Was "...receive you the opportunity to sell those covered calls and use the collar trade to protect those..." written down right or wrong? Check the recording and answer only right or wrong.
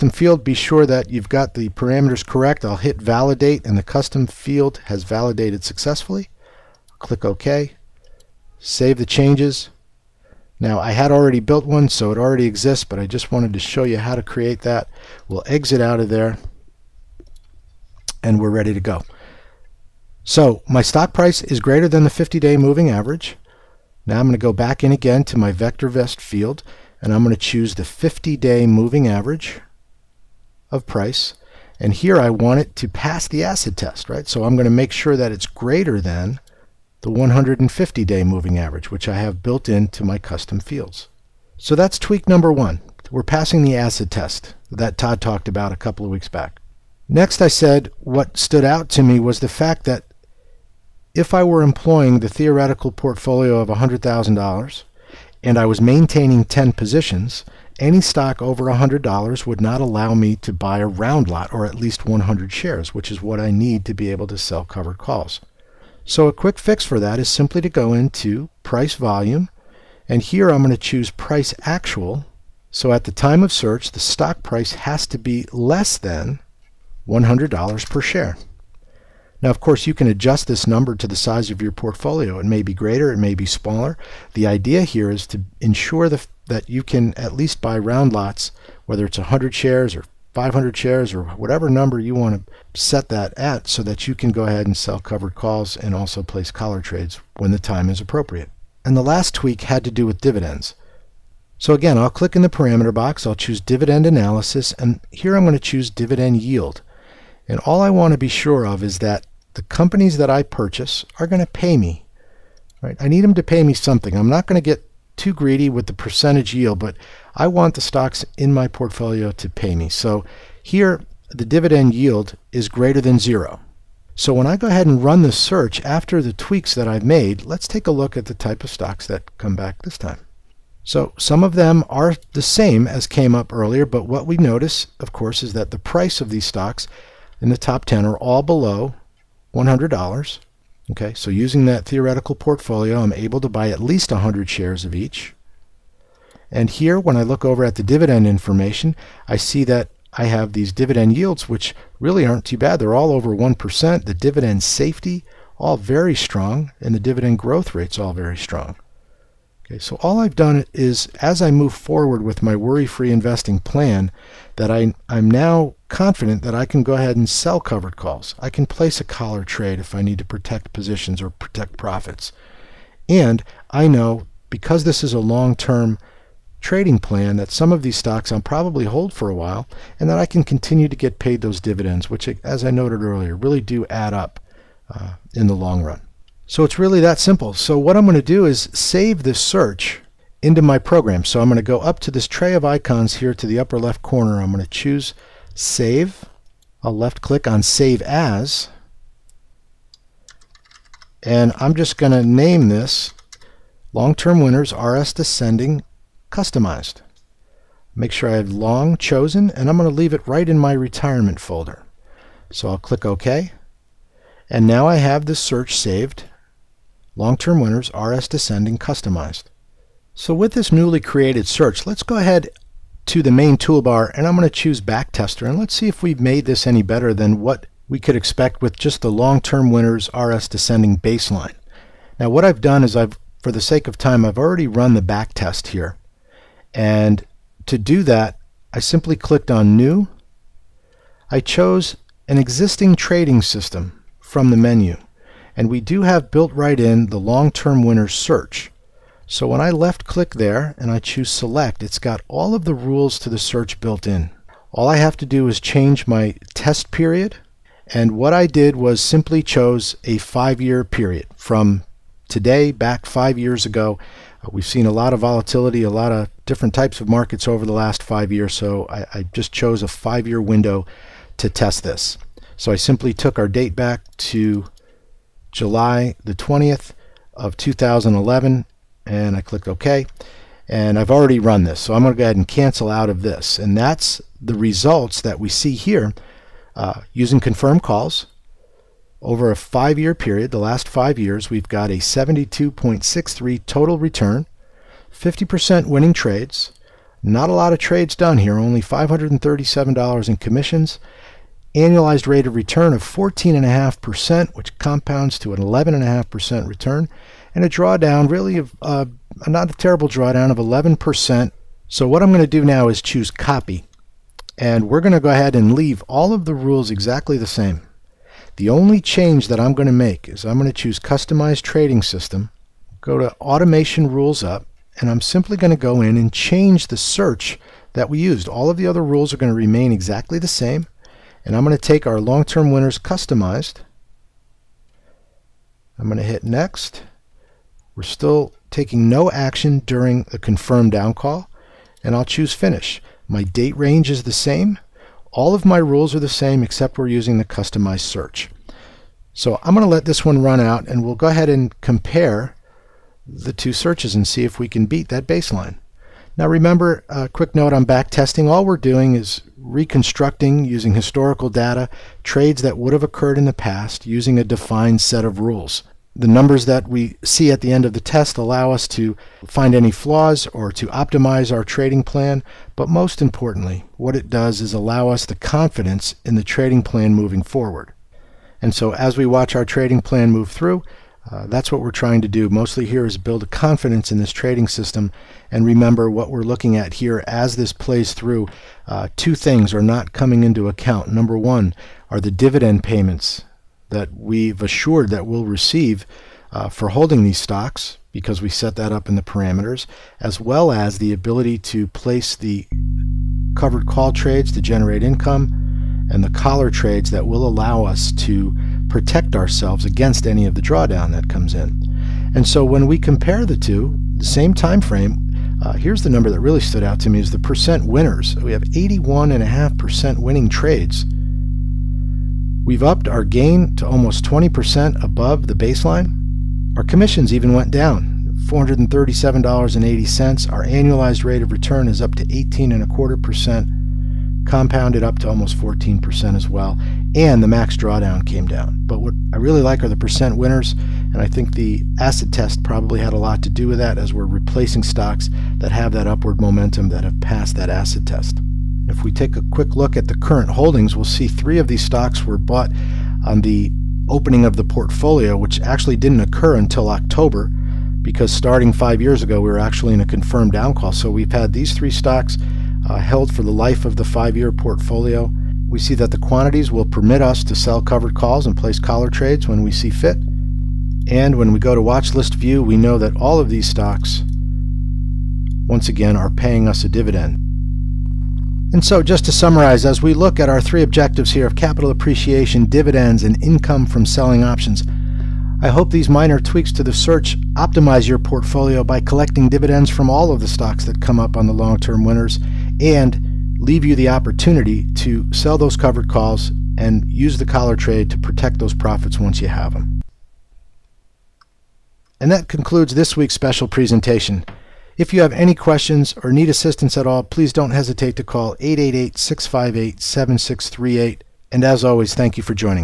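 wrong.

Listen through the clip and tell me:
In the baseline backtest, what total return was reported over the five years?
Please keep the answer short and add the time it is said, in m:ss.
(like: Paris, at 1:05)
72.63, at 4:51.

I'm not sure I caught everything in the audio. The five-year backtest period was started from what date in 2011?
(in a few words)
July 20.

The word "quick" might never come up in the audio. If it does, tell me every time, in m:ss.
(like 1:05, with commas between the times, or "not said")
1:06, 5:57, 7:29.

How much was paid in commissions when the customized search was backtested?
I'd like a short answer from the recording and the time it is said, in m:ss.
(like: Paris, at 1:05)
$437.80, at 7:08.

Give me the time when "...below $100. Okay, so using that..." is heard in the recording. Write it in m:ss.
2:18.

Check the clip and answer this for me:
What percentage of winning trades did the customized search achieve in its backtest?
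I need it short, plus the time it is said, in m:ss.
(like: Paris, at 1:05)
81.5%, at 6:58.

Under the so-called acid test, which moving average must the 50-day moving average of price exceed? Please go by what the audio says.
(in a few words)
150 day moving average.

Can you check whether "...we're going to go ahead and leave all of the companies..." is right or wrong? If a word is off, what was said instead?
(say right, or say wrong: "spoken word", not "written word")
wrong: "rules", not "companies".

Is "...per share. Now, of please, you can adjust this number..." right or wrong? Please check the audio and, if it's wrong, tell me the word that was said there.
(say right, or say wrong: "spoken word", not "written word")
wrong: "course", not "please".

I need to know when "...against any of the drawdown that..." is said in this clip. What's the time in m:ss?
6:49.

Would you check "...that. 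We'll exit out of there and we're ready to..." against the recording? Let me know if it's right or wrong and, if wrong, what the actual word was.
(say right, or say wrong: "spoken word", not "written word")
right.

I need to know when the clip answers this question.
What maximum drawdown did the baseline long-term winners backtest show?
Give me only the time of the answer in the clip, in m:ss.
5:10.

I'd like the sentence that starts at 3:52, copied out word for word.
Now what I've done is I've, for the sake of time, I've already run the back test here.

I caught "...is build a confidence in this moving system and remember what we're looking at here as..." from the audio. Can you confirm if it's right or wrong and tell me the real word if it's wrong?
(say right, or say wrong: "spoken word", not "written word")
wrong: "trading", not "moving".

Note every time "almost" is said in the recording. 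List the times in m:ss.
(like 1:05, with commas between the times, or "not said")
7:03, 7:15.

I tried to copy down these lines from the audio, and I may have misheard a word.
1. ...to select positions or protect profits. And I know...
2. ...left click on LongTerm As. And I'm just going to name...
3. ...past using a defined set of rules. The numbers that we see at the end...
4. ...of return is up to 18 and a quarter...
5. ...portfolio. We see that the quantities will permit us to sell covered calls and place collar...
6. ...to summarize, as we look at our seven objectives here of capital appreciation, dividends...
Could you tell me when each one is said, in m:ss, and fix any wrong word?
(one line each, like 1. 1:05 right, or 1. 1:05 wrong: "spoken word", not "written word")
1. 2:50 wrong: "protect", not "select"
2. 3:16 wrong: "Save", not "LongTerm"
3. 6:03 right
4. 7:11 right
5. 7:44 right
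6. 7:59 wrong: "three", not "seven".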